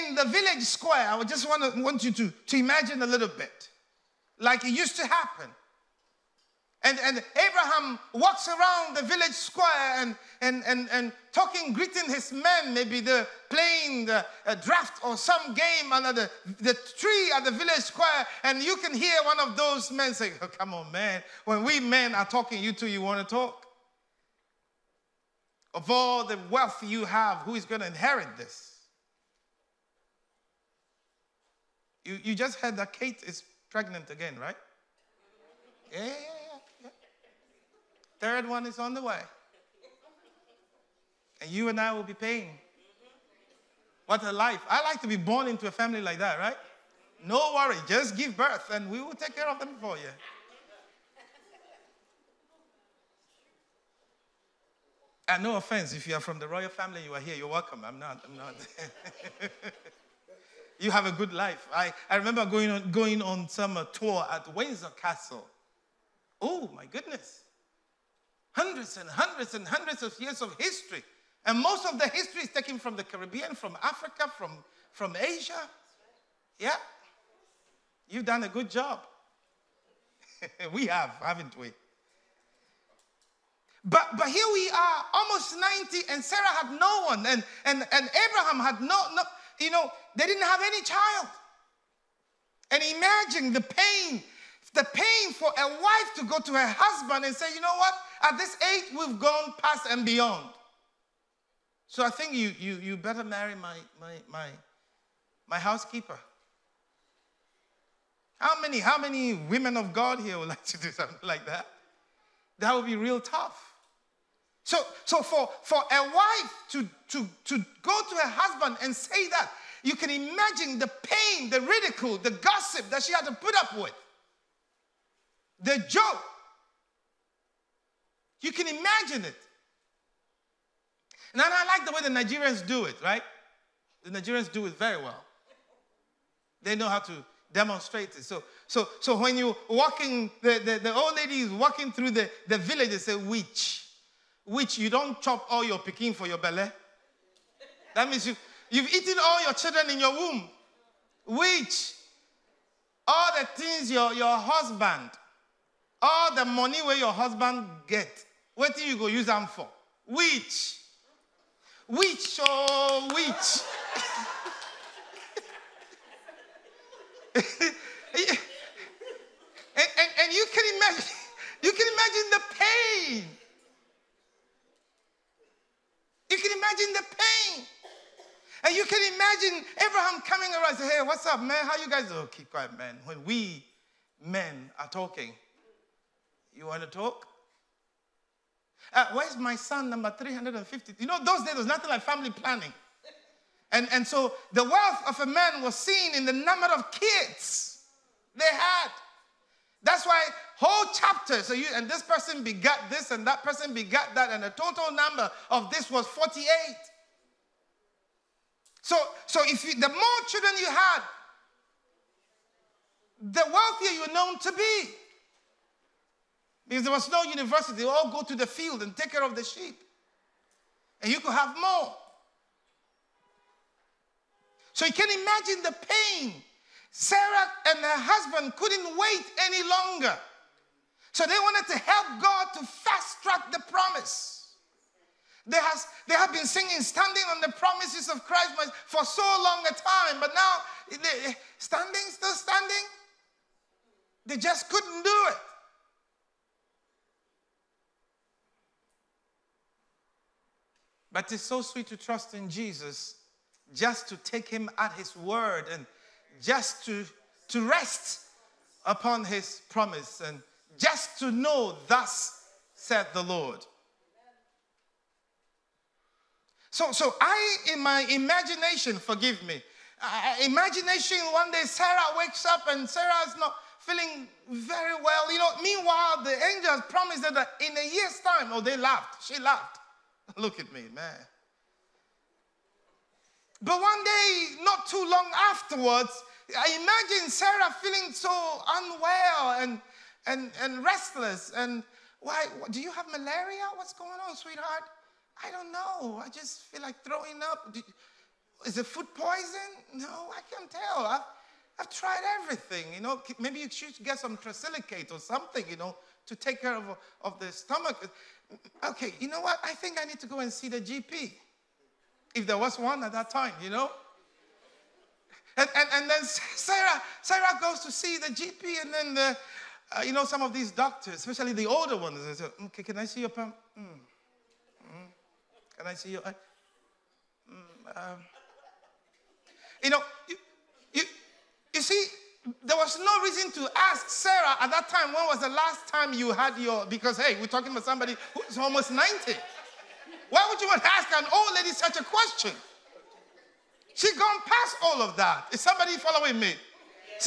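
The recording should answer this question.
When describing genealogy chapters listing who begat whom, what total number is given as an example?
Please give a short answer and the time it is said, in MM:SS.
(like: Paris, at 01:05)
48, at 03:26.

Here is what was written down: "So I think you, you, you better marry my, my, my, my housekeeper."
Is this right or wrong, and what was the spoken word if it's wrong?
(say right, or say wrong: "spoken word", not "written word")
right.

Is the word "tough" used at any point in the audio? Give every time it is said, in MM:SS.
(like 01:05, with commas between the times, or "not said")
01:53.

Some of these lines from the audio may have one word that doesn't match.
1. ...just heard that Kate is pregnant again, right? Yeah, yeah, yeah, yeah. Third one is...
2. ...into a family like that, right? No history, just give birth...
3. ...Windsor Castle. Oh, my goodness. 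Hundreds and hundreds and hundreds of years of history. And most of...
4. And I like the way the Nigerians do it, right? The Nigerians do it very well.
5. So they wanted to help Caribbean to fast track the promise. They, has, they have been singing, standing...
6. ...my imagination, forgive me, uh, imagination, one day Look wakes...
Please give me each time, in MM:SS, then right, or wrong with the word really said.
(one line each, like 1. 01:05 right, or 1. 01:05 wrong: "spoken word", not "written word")
1. 00:32 right
2. 00:45 wrong: "worry", not "history"
3. 01:04 right
4. 02:11 right
5. 03:51 wrong: "God", not "Caribbean"
6. 04:27 wrong: "Sarah", not "Look".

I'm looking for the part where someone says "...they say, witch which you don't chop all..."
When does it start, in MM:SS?
02:22.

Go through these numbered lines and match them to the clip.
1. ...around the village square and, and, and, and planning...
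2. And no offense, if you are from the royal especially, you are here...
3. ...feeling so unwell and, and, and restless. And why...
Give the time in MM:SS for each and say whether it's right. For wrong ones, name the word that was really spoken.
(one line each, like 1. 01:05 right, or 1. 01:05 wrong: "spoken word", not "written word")
1. 00:08 wrong: "talking", not "planning"
2. 00:55 wrong: "family", not "especially"
3. 04:47 right.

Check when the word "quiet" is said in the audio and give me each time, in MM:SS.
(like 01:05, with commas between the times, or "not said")
03:02.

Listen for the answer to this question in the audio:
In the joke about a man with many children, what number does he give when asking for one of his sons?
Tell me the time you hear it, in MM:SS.
03:10.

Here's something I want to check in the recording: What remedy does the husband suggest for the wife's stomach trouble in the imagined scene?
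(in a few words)
trisilicate.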